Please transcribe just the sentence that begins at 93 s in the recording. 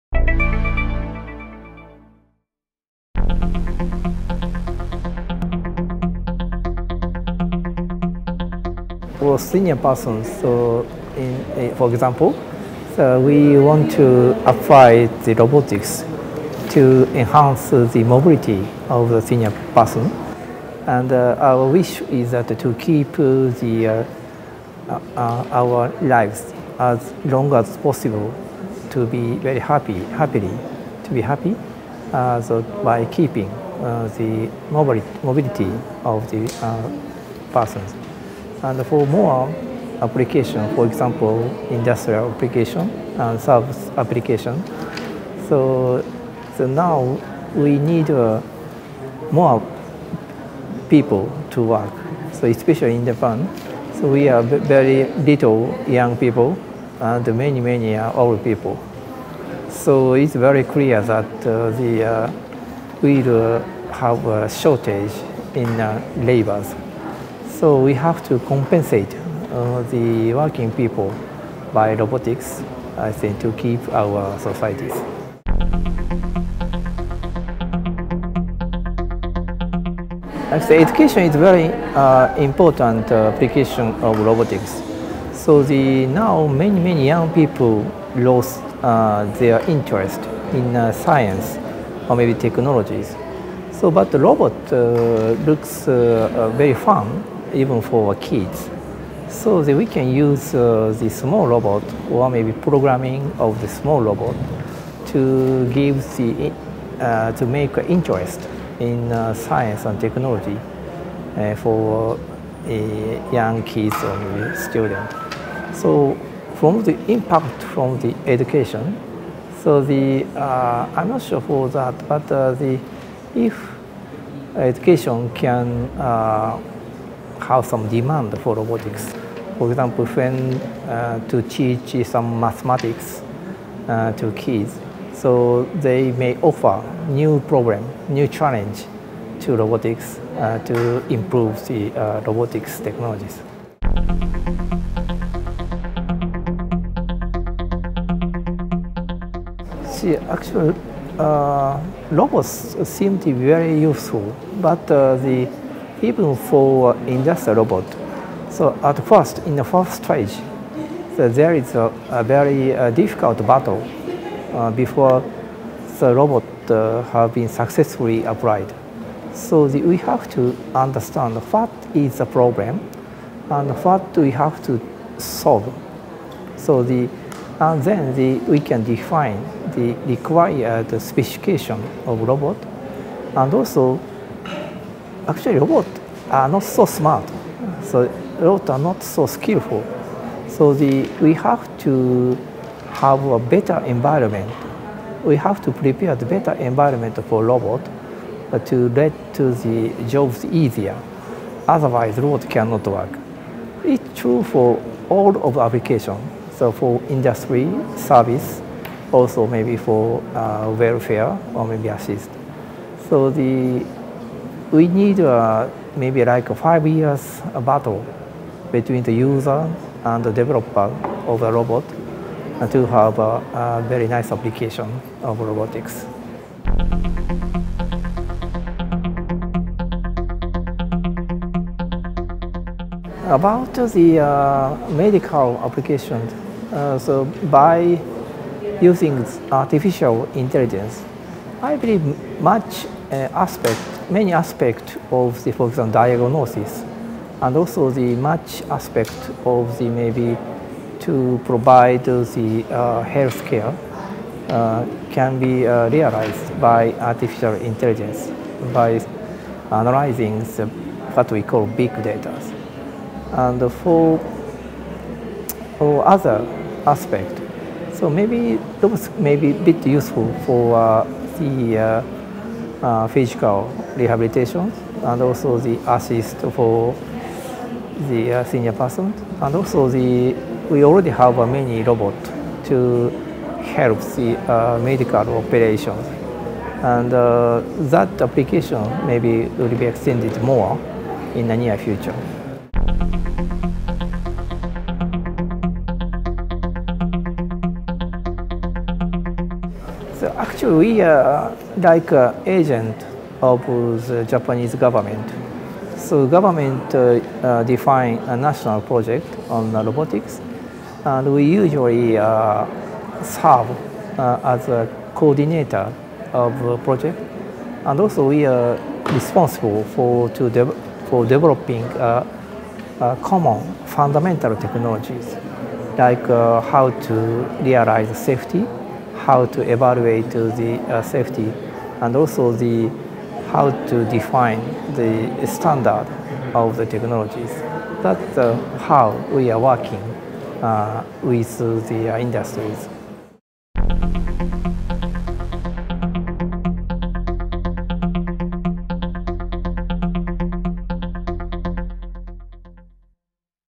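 So, but the robot uh, looks uh, very fun even for kids.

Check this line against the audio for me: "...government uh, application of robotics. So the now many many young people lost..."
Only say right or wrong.
wrong.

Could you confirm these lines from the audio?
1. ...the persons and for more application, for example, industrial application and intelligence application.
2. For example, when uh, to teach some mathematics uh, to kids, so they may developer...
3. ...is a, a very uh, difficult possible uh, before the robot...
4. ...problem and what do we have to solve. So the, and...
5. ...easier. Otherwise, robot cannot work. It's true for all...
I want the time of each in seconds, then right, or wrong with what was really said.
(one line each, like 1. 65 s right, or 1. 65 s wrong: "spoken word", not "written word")
1. 36 s wrong: "service", not "intelligence"
2. 129 s wrong: "offer", not "developer"
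3. 161 s wrong: "battle", not "possible"
4. 172 s right
5. 200 s right.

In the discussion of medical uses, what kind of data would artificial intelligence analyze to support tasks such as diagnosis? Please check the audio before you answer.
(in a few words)
Big data.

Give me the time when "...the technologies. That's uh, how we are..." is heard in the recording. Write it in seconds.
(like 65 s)
336 s.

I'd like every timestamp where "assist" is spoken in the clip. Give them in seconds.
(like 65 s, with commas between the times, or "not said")
211 s, 275 s.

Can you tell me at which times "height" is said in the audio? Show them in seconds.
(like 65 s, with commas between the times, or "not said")
not said.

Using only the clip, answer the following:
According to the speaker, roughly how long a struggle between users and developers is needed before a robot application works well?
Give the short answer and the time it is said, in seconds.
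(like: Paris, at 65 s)
5 years, at 216 s.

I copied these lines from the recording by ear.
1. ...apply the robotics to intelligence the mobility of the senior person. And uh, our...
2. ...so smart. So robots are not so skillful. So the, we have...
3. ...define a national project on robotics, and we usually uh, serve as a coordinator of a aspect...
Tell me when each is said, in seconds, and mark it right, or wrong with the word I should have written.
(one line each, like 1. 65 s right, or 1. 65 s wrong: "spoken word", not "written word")
1. 14 s wrong: "enhance", not "intelligence"
2. 186 s right
3. 307 s wrong: "project", not "aspect".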